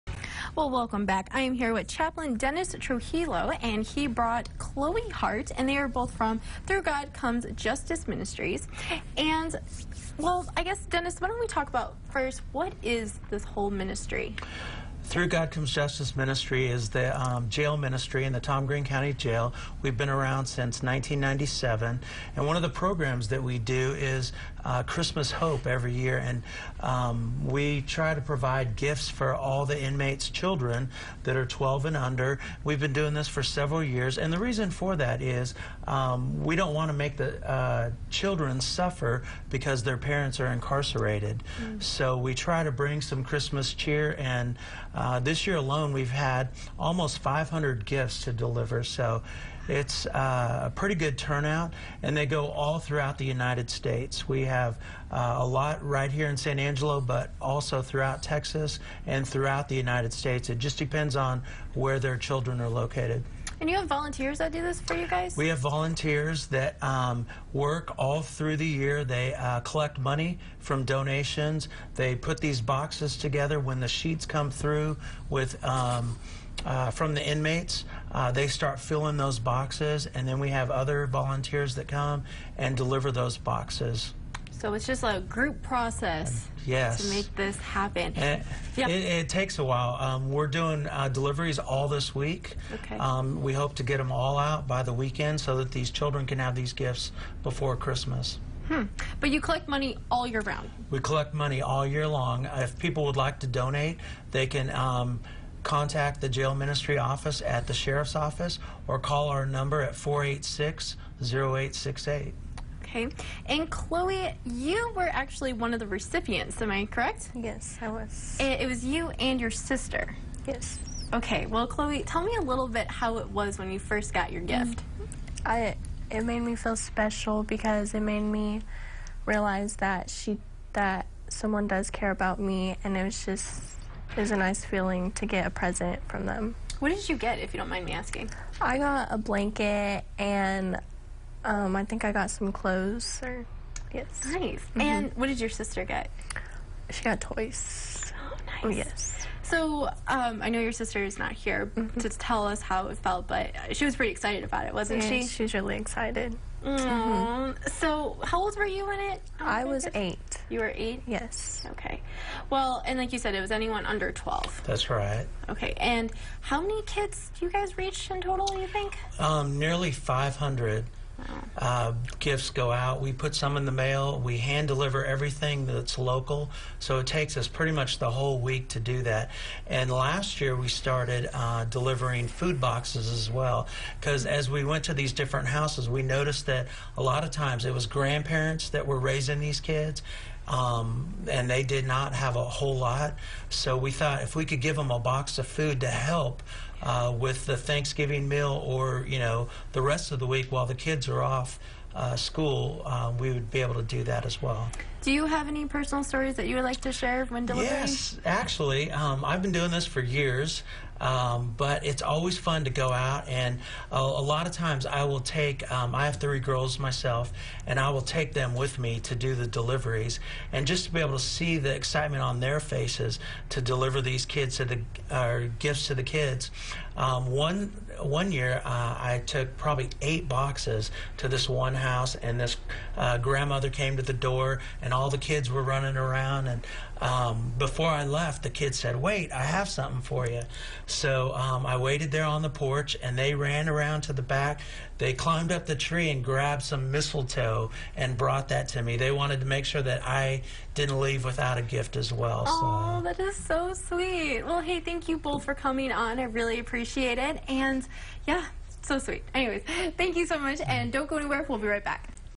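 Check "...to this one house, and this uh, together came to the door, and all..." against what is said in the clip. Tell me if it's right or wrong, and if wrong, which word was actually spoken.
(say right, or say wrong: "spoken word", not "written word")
wrong: "grandmother", not "together".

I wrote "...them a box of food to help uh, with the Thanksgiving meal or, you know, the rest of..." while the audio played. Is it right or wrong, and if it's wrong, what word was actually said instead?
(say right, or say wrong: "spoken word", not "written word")
right.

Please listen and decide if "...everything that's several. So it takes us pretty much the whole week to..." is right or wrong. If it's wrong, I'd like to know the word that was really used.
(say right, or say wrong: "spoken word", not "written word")
wrong: "local", not "several".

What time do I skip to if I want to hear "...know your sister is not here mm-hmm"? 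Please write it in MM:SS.
02:30.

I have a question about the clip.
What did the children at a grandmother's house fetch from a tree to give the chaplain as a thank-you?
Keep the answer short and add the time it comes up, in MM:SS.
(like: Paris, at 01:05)
Mistletoe, at 04:06.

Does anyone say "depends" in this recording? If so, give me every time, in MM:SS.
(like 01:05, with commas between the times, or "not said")
01:00.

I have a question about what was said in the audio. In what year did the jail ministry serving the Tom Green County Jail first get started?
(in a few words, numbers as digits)
1997.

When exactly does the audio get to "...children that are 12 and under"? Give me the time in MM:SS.
00:30.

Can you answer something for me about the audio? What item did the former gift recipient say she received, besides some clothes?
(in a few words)
A blanket.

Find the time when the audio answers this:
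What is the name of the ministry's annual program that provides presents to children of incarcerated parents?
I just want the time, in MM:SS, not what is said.
00:24.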